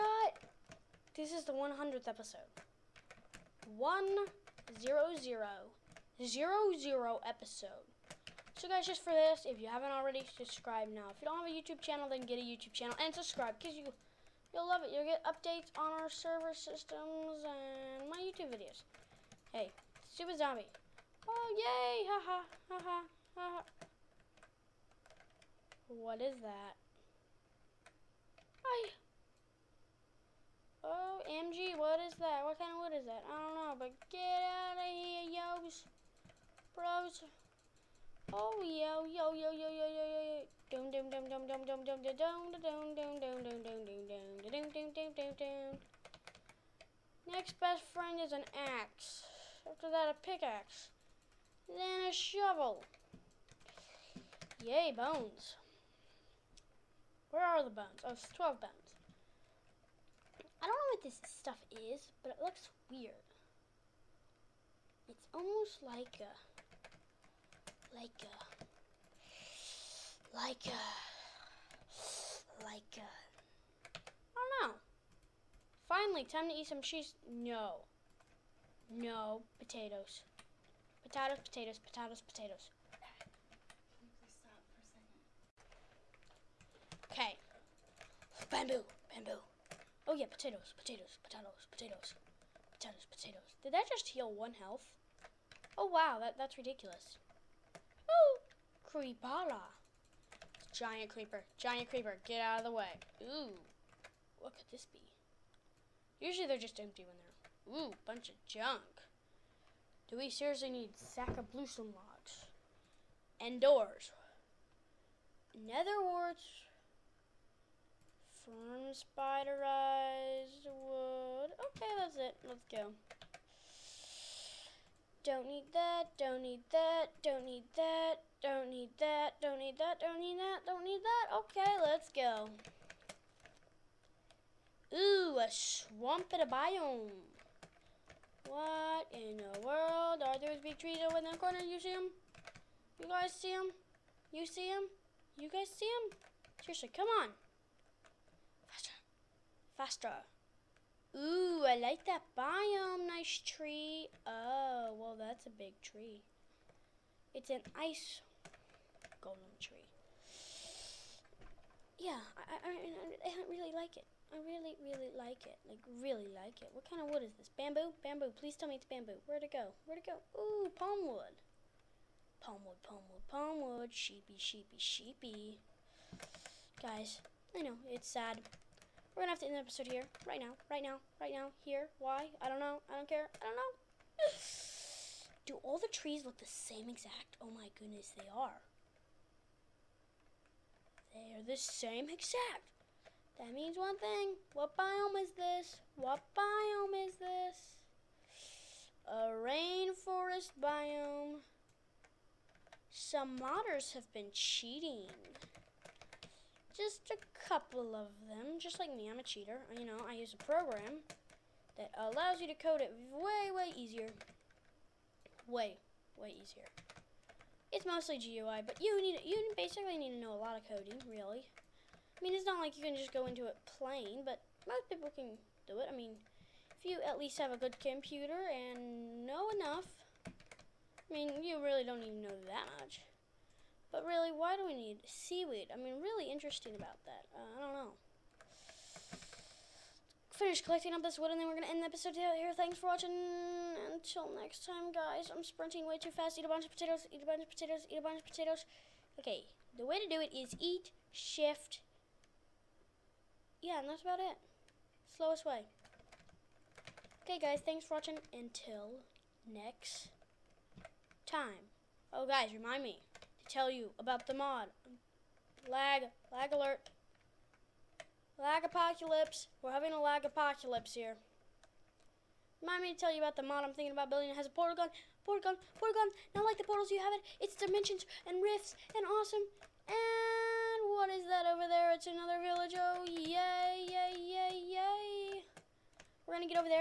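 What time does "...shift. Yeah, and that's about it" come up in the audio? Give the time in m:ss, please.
4:11.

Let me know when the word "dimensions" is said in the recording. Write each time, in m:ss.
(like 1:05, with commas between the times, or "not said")
4:37.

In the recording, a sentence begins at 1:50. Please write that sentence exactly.
Do we seriously need sack of bluesome logs?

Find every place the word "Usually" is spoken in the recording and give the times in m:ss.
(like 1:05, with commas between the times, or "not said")
1:46.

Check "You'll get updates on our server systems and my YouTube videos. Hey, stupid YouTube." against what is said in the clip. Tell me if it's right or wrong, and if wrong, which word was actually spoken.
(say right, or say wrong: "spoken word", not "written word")
wrong: "Zombie", not "YouTube".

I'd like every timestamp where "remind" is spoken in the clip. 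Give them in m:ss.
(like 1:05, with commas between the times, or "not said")
4:22, 4:32.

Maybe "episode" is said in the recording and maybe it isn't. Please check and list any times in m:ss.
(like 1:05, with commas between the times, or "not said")
0:02, 0:07, 2:59, 4:01.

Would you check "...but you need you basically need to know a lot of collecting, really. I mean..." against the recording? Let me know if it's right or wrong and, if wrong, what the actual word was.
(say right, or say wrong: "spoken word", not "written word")
wrong: "coding", not "collecting".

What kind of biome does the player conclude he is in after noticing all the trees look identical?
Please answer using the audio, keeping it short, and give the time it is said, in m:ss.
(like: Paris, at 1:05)
Rainforest biome, at 3:19.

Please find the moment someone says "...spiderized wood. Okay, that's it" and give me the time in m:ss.
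1:58.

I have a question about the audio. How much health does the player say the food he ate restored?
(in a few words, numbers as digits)
1 health.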